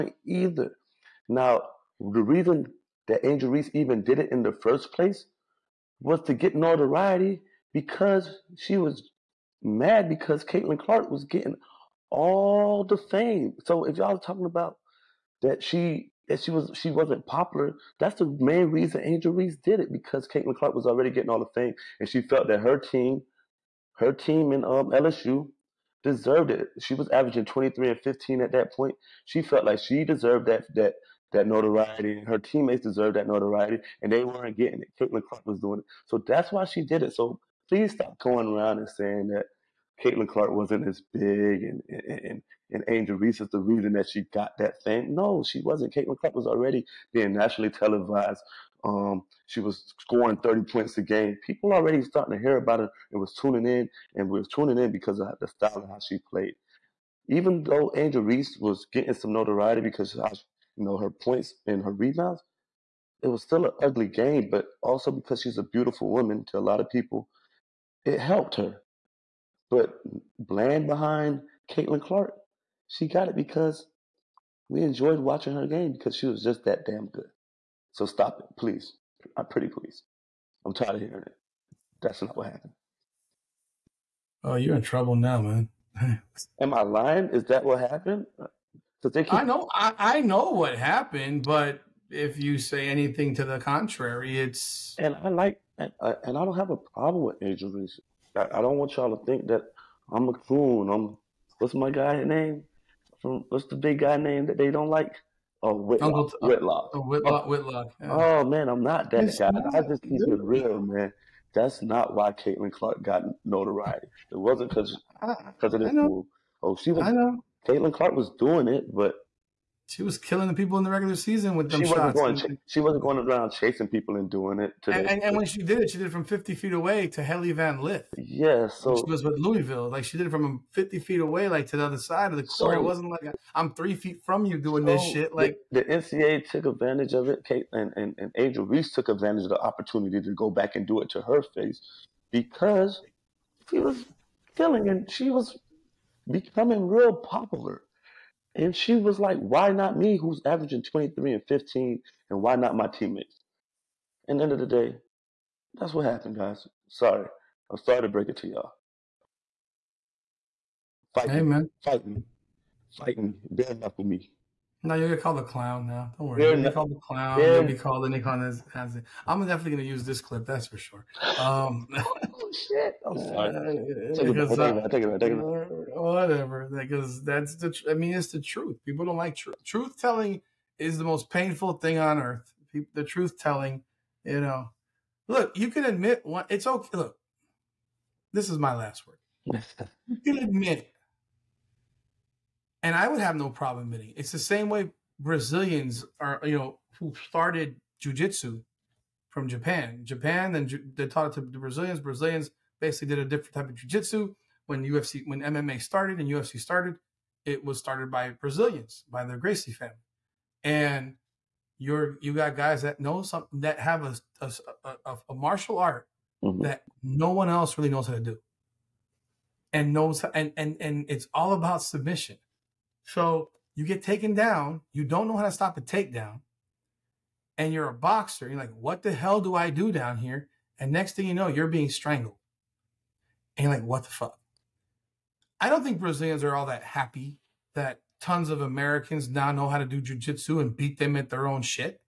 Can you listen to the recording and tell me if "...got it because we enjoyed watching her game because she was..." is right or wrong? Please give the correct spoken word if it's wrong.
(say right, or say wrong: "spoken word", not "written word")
right.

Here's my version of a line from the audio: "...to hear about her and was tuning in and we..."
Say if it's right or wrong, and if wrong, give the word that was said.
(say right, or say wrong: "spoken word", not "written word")
right.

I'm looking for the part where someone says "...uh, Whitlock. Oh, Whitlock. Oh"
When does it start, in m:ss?
1:46.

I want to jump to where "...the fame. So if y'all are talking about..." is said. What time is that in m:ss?
0:12.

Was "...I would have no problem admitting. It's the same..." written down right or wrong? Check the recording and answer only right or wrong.
right.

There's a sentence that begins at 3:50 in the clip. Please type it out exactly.
And next thing you know, you're being strangled.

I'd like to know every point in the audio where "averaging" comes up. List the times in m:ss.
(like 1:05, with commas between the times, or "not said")
0:27, 2:30.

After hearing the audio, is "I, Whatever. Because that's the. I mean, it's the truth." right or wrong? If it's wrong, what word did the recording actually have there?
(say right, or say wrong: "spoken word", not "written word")
right.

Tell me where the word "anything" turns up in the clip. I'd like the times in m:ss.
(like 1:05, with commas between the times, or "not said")
1:32.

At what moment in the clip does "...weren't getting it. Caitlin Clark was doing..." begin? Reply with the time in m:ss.
0:34.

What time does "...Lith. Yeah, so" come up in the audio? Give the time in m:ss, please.
2:07.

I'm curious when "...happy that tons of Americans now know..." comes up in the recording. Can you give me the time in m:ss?
3:56.